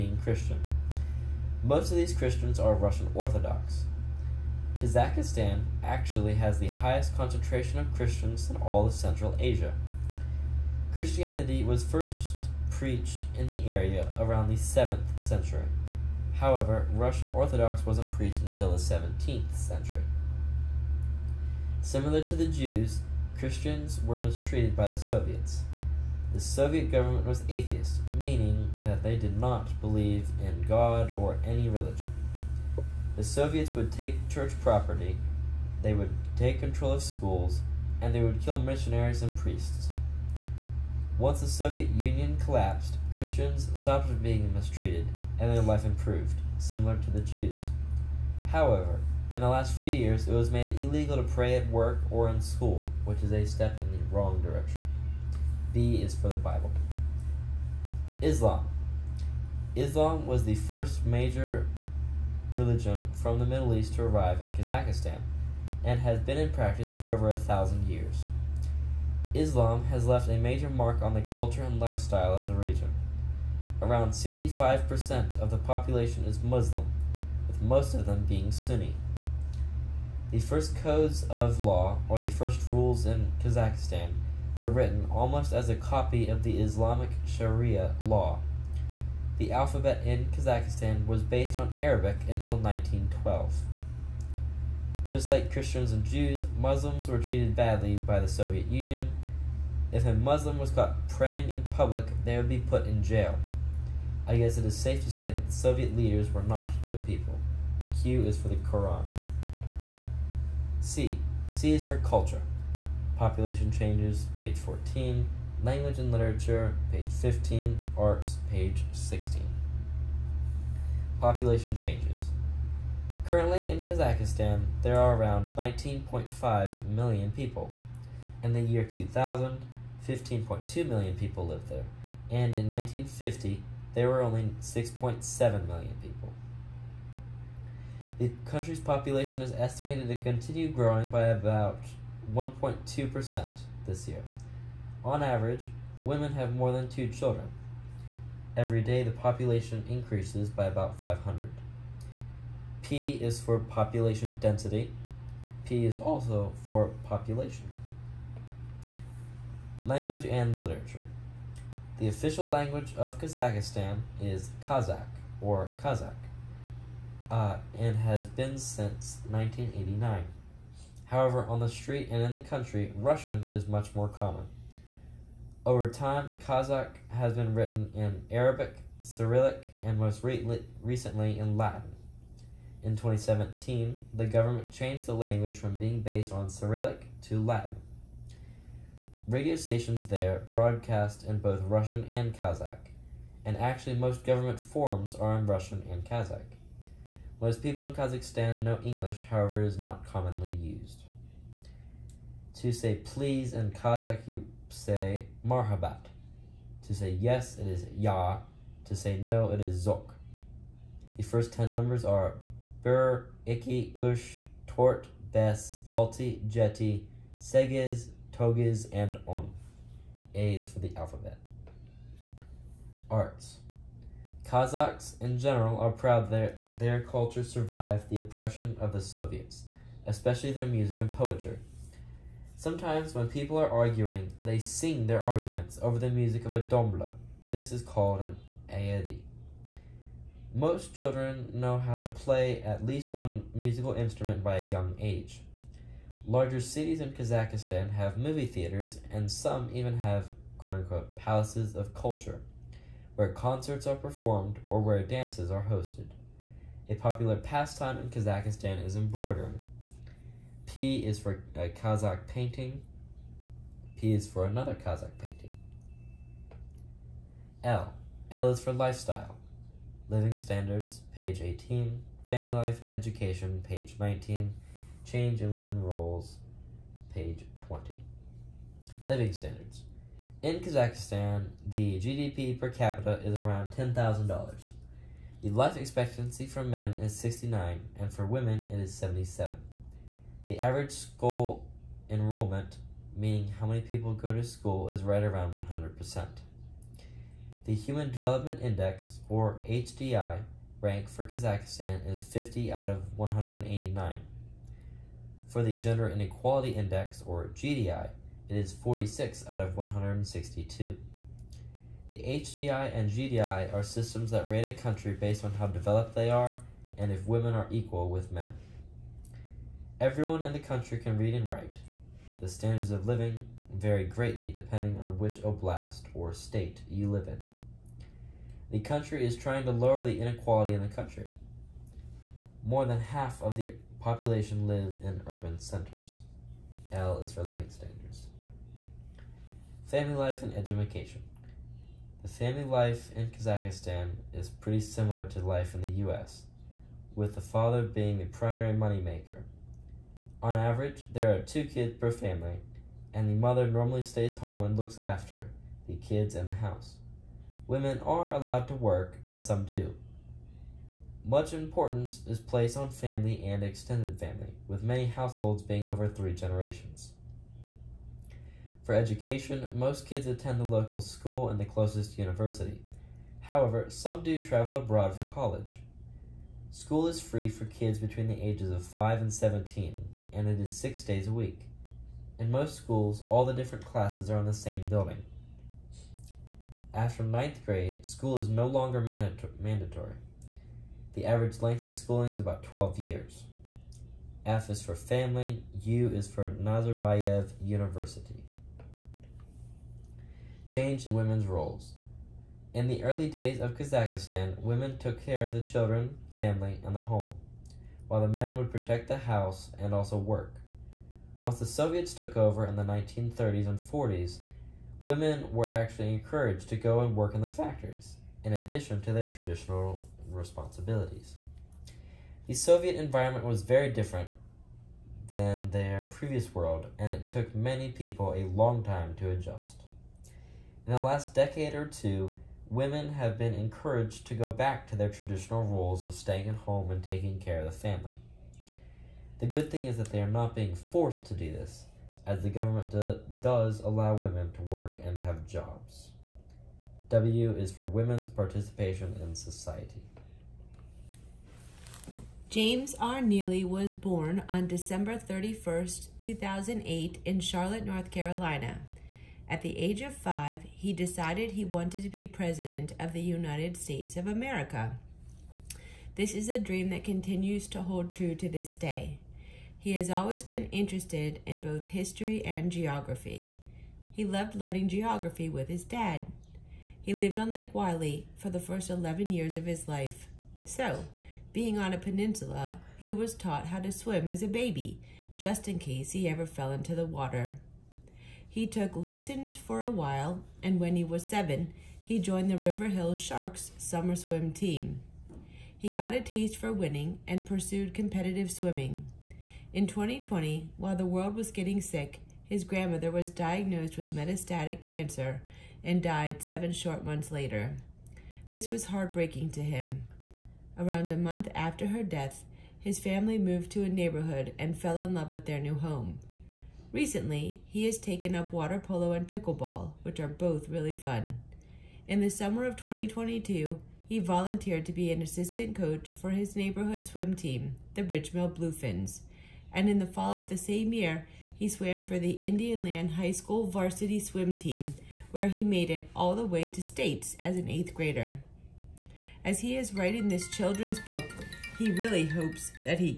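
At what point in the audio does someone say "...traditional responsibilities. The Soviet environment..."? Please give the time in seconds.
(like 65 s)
419 s.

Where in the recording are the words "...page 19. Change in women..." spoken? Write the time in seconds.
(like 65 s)
273 s.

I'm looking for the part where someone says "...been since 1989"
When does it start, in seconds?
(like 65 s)
168 s.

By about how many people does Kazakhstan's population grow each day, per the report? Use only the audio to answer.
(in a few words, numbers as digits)
500.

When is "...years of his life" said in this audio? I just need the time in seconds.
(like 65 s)
479 s.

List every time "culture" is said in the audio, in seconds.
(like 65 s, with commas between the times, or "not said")
71 s, 111 s, 227 s, 251 s.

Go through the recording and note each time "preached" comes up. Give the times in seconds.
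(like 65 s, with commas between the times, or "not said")
12 s, 18 s.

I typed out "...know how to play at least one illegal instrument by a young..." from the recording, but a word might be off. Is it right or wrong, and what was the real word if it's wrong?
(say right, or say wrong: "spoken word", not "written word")
wrong: "musical", not "illegal".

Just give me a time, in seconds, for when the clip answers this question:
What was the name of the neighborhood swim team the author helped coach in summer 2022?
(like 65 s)
528 s.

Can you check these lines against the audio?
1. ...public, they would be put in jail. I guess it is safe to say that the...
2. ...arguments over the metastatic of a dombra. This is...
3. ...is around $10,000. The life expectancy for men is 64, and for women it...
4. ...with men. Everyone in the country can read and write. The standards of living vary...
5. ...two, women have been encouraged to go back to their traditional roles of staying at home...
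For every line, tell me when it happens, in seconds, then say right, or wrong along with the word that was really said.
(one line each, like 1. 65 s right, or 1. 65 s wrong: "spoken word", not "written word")
1. 101 s right
2. 235 s wrong: "music", not "metastatic"
3. 283 s wrong: "69", not "64"
4. 318 s right
5. 431 s right.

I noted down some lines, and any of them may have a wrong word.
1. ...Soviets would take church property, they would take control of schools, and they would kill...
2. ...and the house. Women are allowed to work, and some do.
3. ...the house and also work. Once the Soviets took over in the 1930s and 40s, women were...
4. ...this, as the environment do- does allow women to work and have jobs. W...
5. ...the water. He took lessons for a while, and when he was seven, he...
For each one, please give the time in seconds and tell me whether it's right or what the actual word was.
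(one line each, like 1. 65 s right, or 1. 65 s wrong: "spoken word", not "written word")
1. 33 s right
2. 356 s right
3. 409 s right
4. 441 s wrong: "government", not "environment"
5. 486 s right.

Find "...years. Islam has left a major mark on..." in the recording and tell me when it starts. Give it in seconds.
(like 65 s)
67 s.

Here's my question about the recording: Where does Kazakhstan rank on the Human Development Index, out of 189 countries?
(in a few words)
50.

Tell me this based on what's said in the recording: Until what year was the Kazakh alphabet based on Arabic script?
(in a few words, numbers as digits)
1912.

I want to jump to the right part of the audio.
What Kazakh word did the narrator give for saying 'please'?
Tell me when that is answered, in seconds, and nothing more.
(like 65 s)
205 s.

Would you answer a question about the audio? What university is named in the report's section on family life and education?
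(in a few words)
Nazarbayev University.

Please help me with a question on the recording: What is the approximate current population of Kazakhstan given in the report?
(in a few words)
19.5 million.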